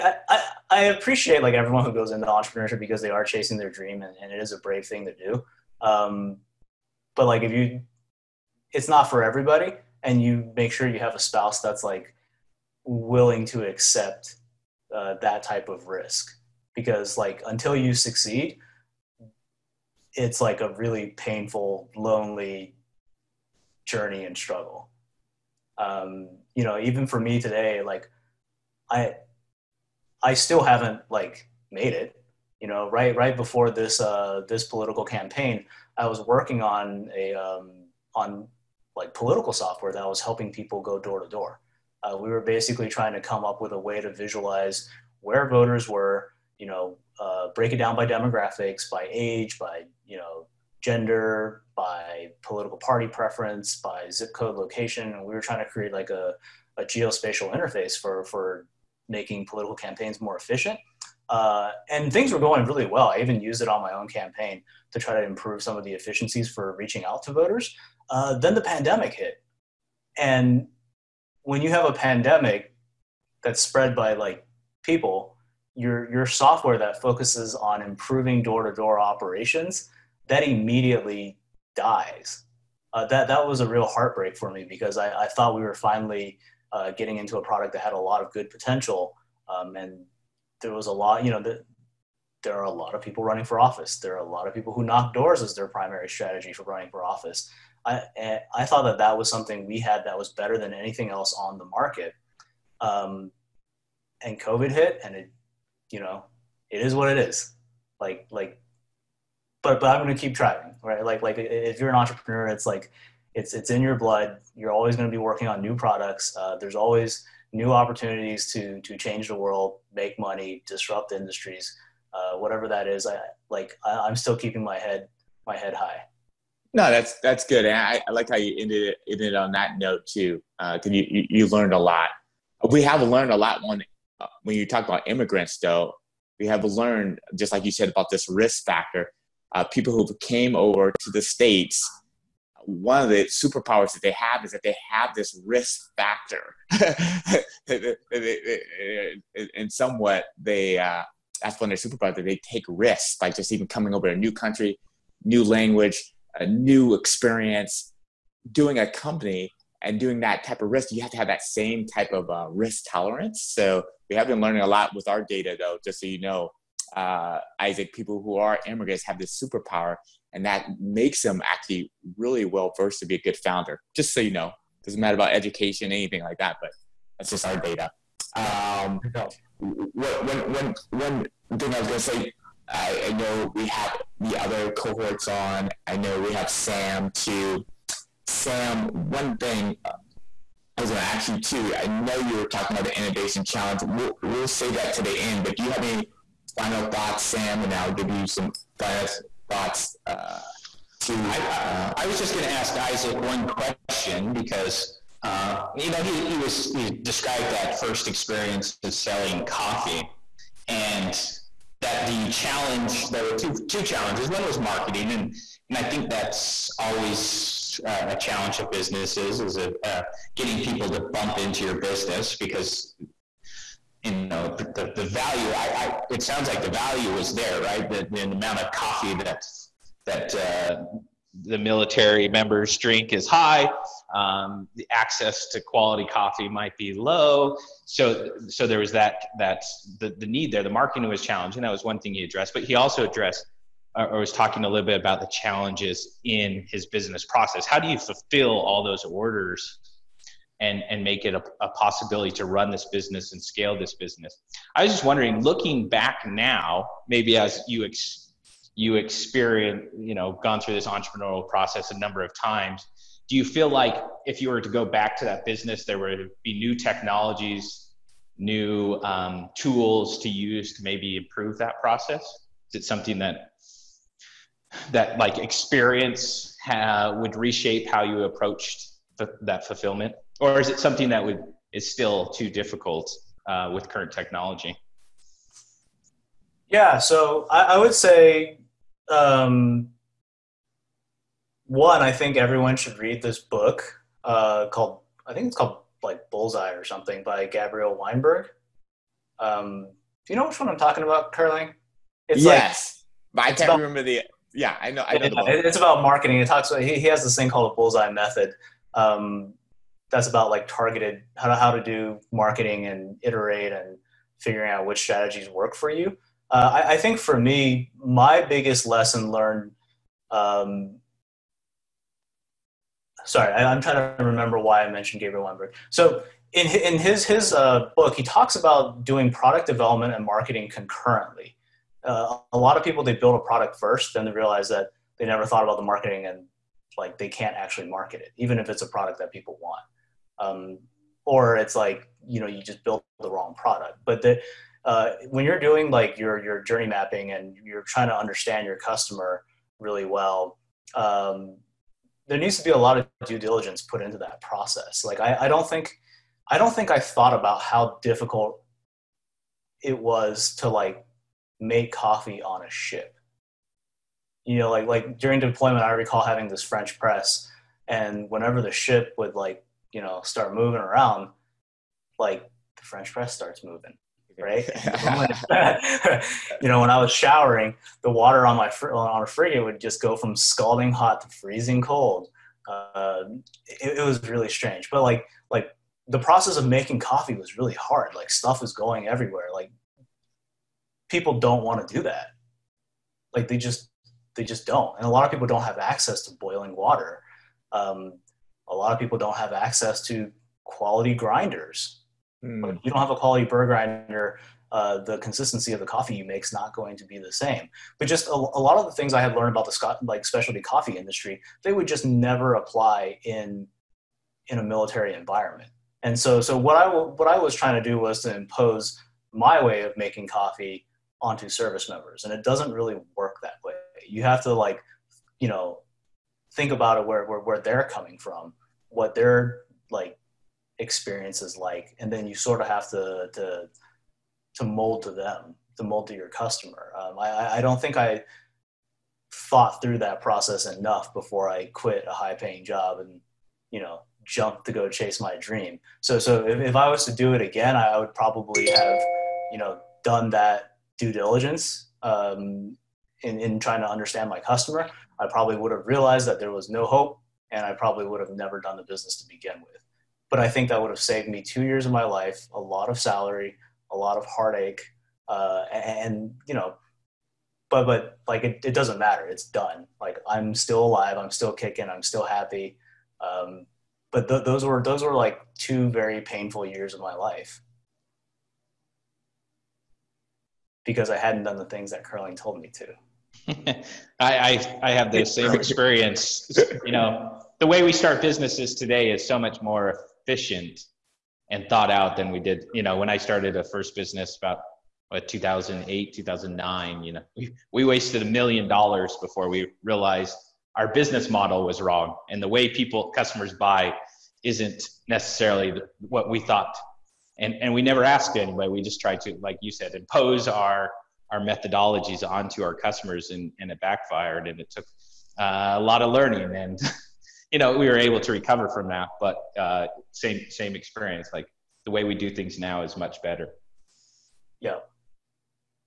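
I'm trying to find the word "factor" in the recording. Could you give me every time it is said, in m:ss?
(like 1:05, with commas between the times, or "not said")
2:18, 2:25.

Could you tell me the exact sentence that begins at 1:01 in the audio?
Uh, and things were going really well.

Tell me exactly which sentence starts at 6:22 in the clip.
Uh, it, it was really strange, but like like the process of making coffee was really hard.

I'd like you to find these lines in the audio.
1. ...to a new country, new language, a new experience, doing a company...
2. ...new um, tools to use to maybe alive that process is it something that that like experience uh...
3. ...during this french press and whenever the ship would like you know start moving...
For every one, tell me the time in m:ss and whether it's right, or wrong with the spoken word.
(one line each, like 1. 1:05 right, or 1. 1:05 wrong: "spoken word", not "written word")
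1. 2:34 right
2. 4:28 wrong: "improve", not "alive"
3. 6:06 wrong: "having", not "during".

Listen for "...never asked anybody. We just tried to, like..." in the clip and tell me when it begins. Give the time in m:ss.
8:27.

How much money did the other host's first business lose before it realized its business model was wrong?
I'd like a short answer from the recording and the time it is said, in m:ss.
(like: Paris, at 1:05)
a million dollars, at 8:18.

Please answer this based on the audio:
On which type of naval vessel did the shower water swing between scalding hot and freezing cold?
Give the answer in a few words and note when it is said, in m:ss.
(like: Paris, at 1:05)
frigate, at 6:19.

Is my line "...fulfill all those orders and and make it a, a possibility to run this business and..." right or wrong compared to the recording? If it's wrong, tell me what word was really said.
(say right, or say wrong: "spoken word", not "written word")
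right.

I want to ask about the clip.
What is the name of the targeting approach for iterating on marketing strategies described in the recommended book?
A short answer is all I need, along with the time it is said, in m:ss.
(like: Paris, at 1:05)
bullseye method, at 5:07.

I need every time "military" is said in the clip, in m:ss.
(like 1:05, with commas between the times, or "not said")
3:51, 6:54.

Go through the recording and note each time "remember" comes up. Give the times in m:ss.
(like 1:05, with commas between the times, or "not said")
5:03, 5:24.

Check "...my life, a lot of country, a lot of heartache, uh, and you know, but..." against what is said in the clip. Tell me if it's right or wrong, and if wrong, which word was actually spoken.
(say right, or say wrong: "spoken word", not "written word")
wrong: "salary", not "country".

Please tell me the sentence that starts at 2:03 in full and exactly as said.
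I like I, am still keeping my head my head high.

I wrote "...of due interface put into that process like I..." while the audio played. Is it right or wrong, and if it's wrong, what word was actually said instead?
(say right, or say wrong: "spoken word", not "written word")
wrong: "diligence", not "interface".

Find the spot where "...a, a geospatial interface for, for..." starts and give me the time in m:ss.
0:56.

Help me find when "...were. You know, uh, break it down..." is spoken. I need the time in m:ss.
0:45.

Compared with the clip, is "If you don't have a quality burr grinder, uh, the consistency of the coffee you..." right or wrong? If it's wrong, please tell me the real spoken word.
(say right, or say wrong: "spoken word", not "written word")
right.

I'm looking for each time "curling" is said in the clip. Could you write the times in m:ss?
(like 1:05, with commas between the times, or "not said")
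5:01, 8:02.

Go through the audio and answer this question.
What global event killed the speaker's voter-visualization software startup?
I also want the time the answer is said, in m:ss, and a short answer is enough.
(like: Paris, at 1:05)
the pandemic, at 1:08.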